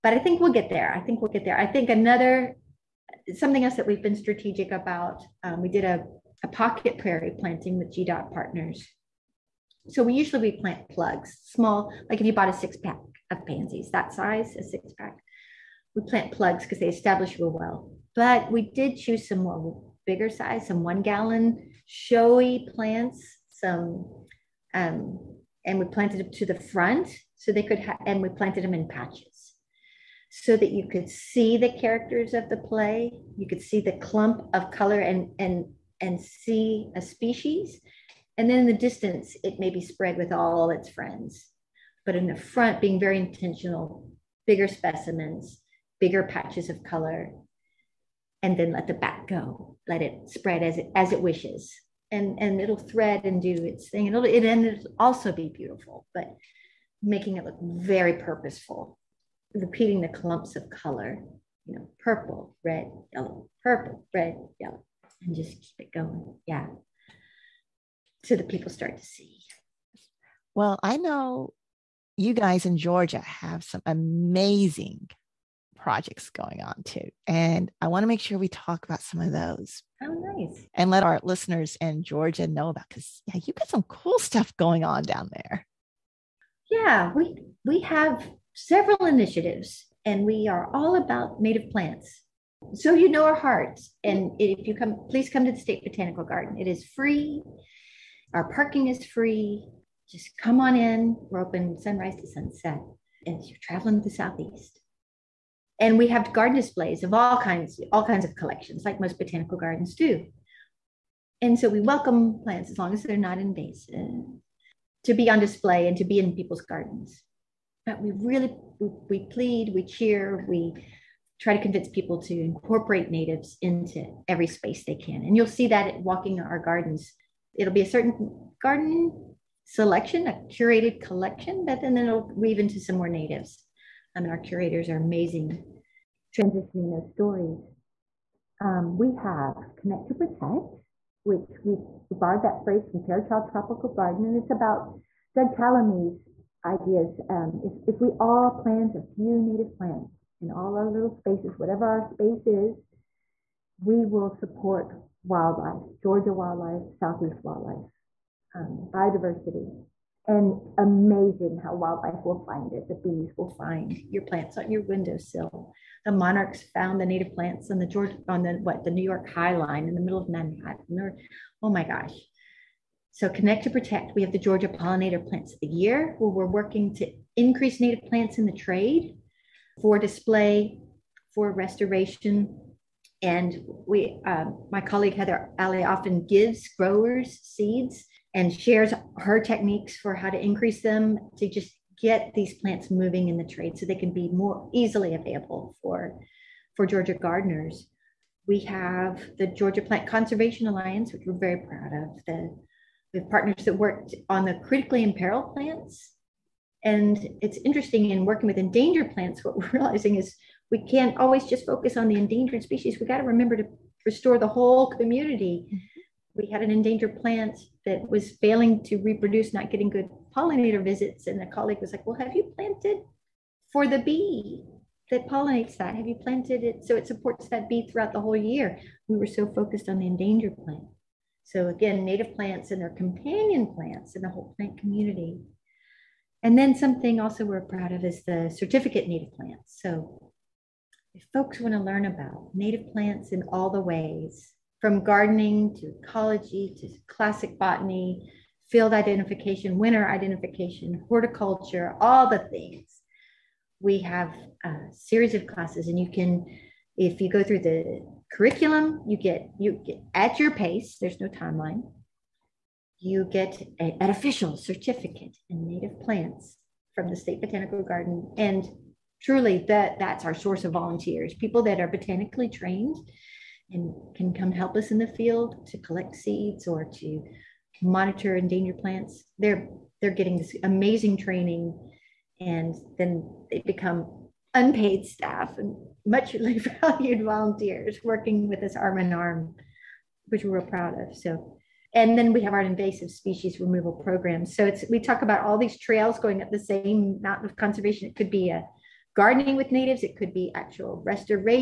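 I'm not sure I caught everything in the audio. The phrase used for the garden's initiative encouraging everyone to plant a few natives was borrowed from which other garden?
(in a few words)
Fairchild Tropical Garden.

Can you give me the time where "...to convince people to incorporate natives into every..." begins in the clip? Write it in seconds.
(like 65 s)
121 s.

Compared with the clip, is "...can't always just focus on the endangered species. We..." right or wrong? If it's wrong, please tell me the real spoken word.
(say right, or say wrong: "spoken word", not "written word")
right.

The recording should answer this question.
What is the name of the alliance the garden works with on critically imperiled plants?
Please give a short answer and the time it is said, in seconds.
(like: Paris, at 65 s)
Georgia Plant Conservation Alliance, at 199 s.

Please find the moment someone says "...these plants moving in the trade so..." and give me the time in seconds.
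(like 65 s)
192 s.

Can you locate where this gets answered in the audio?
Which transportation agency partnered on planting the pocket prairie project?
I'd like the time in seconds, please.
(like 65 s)
7 s.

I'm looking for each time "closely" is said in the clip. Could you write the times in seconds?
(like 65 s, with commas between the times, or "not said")
not said.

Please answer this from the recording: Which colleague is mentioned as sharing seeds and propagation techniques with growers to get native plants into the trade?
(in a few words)
Heather Alley.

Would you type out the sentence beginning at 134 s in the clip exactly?
I mean, our curators are amazing transitioning those stories.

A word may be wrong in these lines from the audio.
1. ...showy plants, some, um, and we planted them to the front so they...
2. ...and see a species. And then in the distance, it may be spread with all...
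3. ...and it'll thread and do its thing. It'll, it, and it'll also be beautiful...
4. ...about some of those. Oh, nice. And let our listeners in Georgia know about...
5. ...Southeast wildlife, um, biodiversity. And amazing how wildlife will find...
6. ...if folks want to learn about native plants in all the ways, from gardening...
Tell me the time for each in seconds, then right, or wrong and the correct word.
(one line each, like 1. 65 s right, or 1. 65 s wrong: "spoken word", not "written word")
1. 21 s right
2. 35 s right
3. 52 s right
4. 78 s right
5. 156 s right
6. 241 s right.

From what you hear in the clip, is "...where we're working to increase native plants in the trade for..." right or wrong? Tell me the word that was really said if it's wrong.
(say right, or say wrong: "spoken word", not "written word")
right.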